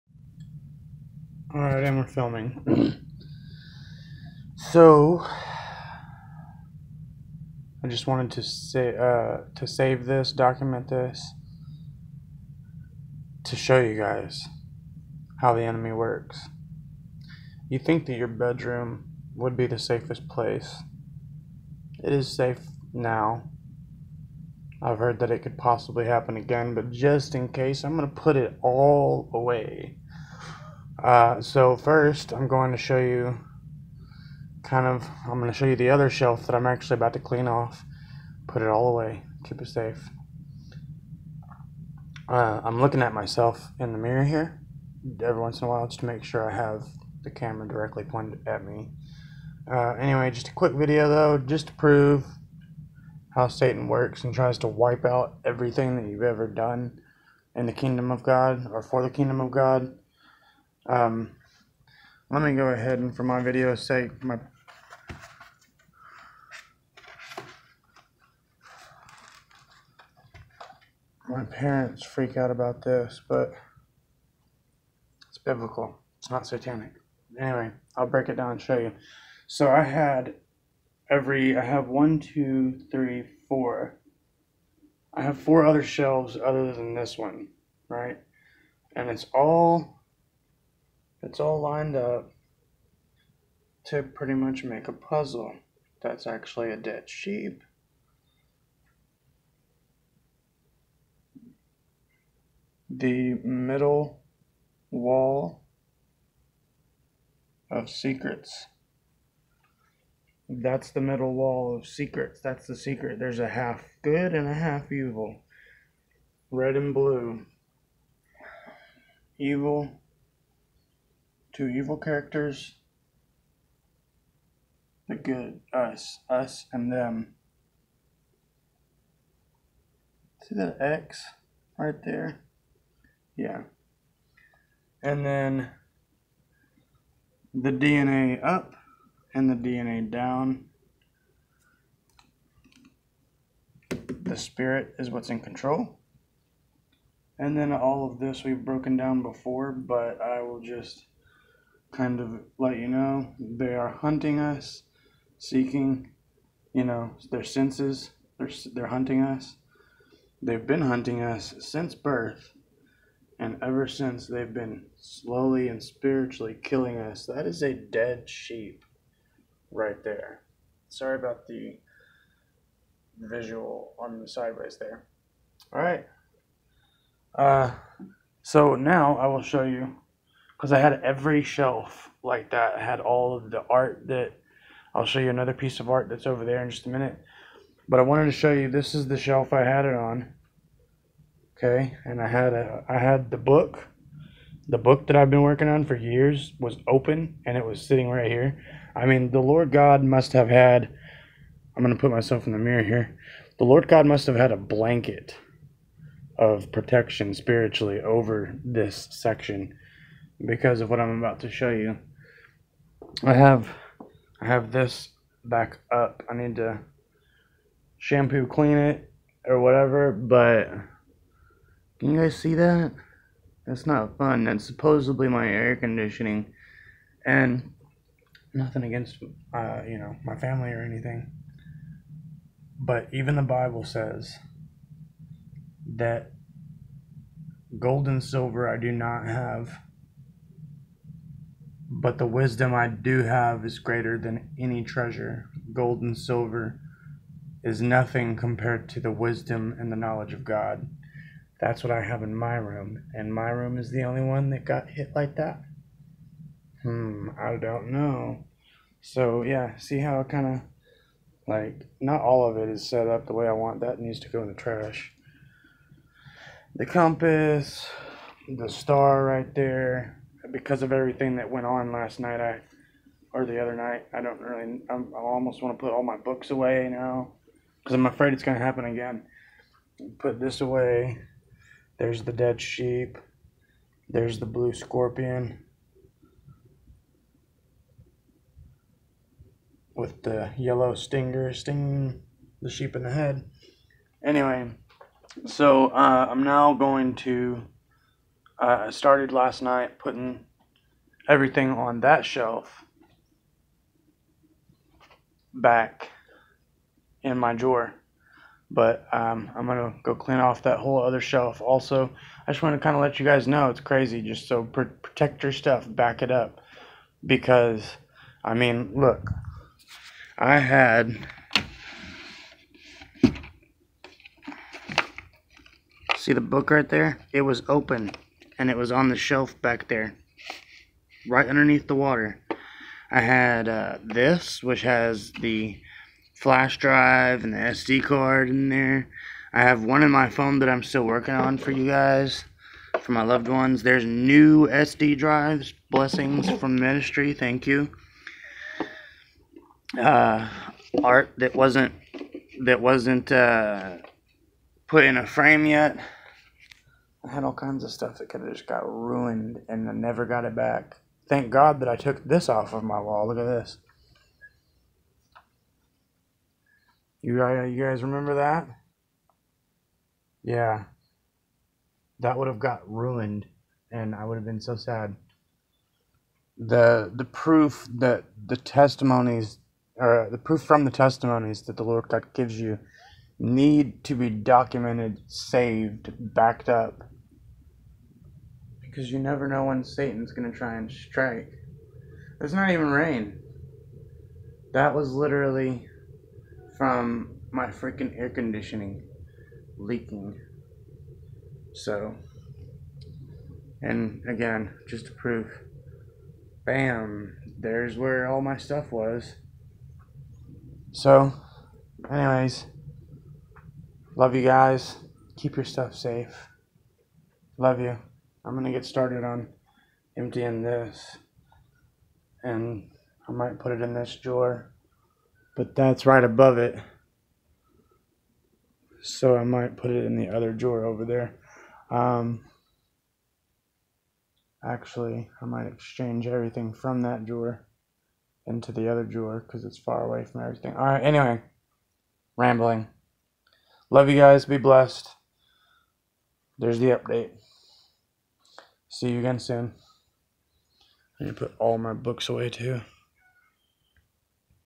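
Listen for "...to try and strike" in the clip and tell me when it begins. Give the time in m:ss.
6:30.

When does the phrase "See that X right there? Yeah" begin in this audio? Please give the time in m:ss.
2:10.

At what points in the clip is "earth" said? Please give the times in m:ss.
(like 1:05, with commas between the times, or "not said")
not said.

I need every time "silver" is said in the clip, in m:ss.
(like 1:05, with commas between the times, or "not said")
3:58, 4:06.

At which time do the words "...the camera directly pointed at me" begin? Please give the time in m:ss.
0:47.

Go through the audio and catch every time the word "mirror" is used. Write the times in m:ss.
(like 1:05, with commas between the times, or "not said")
0:43, 3:22.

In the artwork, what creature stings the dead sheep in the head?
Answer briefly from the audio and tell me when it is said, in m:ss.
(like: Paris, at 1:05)
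Blue scorpion, at 4:44.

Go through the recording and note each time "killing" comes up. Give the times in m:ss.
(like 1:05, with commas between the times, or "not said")
2:46.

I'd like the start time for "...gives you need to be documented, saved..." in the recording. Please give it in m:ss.
6:22.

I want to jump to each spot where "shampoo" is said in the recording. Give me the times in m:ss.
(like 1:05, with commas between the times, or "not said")
3:37.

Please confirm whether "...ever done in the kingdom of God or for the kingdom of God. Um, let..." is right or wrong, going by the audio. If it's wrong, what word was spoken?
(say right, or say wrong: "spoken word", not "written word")
right.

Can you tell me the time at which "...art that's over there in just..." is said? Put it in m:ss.
3:05.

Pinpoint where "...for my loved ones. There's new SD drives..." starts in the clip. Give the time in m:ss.
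5:42.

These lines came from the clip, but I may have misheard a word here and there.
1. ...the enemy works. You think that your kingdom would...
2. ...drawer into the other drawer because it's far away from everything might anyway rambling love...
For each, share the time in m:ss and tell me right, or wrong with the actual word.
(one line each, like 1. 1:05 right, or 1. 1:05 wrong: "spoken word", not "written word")
1. 0:15 wrong: "bedroom", not "kingdom"
2. 7:17 wrong: "alright", not "might".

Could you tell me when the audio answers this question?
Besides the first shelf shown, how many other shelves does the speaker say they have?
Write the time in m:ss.
1:25.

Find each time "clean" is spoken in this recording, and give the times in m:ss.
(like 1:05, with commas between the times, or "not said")
0:37, 3:38, 5:10.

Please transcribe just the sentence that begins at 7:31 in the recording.
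I going to put all my books away too.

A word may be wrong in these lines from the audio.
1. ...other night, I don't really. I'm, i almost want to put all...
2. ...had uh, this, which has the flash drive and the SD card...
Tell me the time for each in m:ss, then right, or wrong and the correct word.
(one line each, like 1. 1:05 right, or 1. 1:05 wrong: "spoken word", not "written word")
1. 4:33 right
2. 5:33 right.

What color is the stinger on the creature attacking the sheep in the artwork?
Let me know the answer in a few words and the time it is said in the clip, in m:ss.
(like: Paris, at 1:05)
Yellow, at 4:50.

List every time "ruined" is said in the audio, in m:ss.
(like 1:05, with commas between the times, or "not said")
5:58, 6:12.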